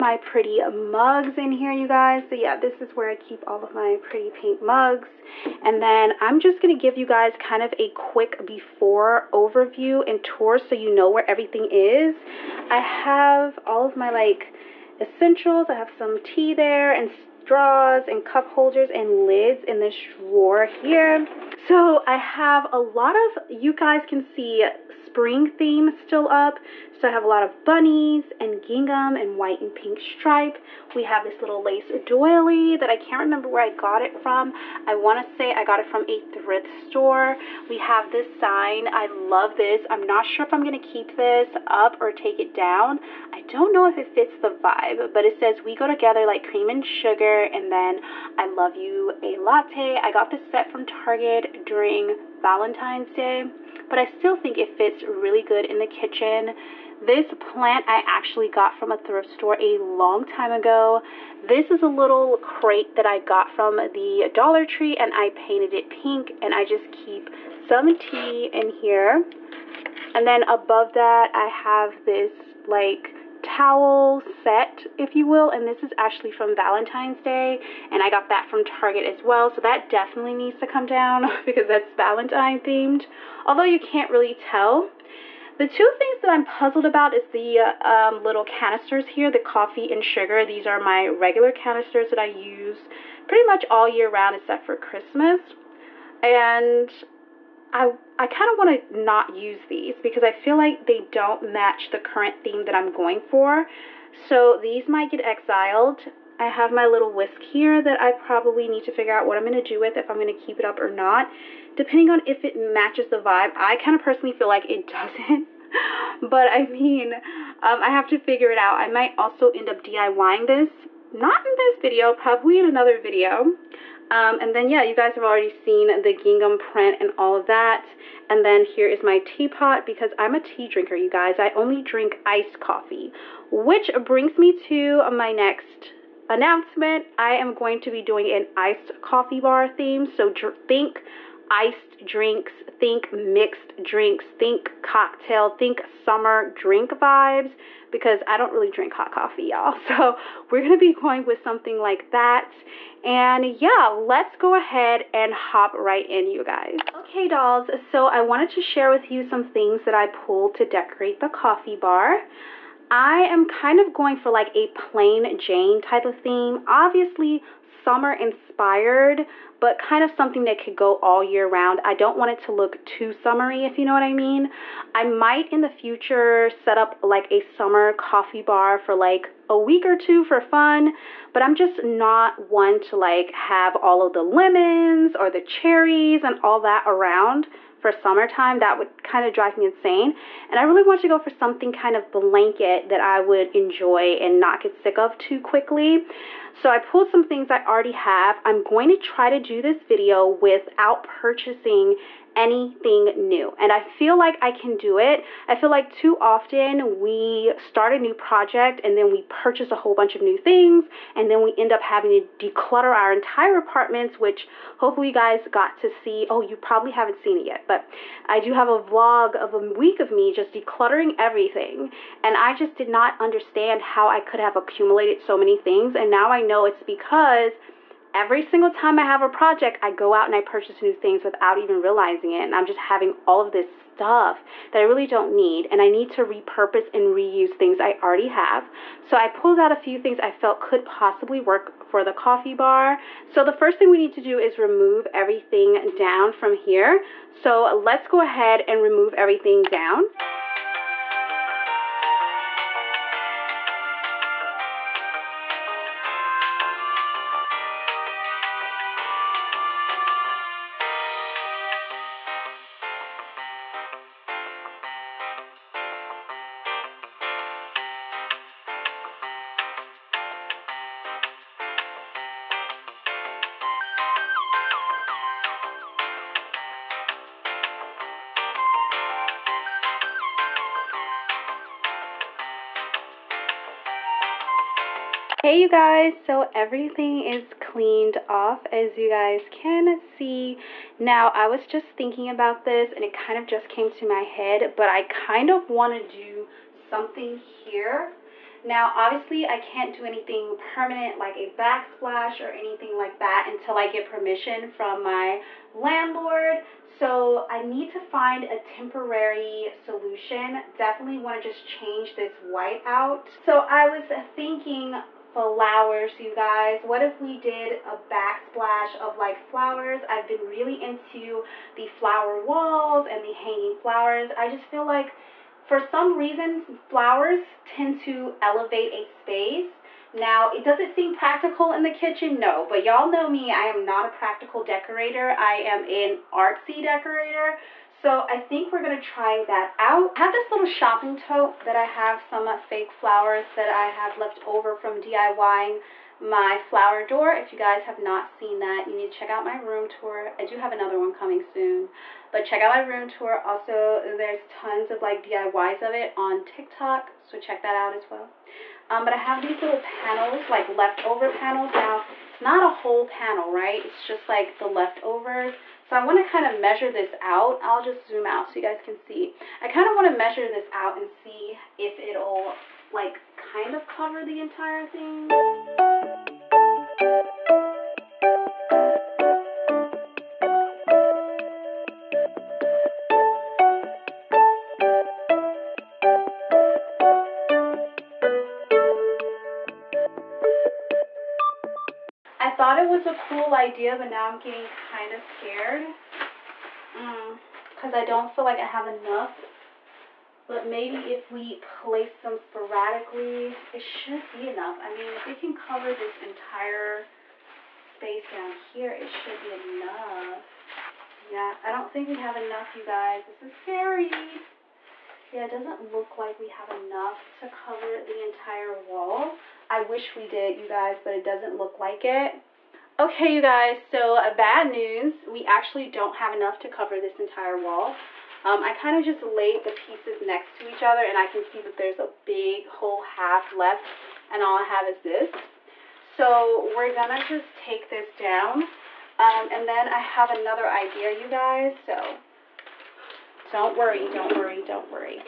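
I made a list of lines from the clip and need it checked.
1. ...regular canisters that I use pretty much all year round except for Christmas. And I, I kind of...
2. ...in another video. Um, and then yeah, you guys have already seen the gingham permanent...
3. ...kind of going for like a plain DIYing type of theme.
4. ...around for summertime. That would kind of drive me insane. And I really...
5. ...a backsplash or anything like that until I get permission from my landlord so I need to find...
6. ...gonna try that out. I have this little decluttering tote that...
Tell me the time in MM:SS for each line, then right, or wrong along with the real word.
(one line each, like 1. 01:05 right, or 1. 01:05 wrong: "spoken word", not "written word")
1. 01:31 right
2. 02:02 wrong: "print", not "permanent"
3. 02:43 wrong: "Jane", not "DIYing"
4. 03:06 right
5. 05:01 right
6. 05:38 wrong: "shopping", not "decluttering".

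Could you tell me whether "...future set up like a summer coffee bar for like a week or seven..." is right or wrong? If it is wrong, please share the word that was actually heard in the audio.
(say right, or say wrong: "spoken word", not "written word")
wrong: "two", not "seven".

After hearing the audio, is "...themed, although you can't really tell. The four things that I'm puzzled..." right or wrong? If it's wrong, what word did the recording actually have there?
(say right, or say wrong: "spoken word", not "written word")
wrong: "two", not "four".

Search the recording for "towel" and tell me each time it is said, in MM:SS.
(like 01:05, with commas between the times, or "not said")
01:13.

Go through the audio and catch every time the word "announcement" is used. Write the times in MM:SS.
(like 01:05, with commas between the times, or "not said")
02:16.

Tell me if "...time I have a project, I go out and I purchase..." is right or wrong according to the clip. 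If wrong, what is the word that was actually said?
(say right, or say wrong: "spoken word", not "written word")
right.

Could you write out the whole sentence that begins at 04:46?
so everything is cleaned off as you guys can see.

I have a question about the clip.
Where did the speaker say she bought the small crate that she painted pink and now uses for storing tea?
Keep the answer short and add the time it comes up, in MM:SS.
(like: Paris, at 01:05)
Dollar Tree, at 01:04.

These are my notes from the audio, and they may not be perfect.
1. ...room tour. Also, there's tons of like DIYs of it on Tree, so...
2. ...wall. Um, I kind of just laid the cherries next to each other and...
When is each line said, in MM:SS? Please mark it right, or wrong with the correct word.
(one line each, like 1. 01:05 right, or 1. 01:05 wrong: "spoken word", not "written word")
1. 05:52 wrong: "TikTok", not "Tree"
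2. 07:07 wrong: "pieces", not "cherries".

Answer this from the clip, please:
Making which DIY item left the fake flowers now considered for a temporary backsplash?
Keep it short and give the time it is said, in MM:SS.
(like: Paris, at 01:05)
flower door, at 05:46.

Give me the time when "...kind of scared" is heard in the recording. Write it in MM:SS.
06:34.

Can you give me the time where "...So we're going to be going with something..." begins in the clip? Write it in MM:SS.
02:29.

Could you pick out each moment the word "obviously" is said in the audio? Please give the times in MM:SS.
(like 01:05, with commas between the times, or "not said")
02:46, 04:58.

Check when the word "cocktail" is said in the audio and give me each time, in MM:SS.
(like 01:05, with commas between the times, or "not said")
02:24.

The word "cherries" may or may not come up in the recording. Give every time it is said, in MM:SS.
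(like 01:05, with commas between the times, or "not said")
03:05.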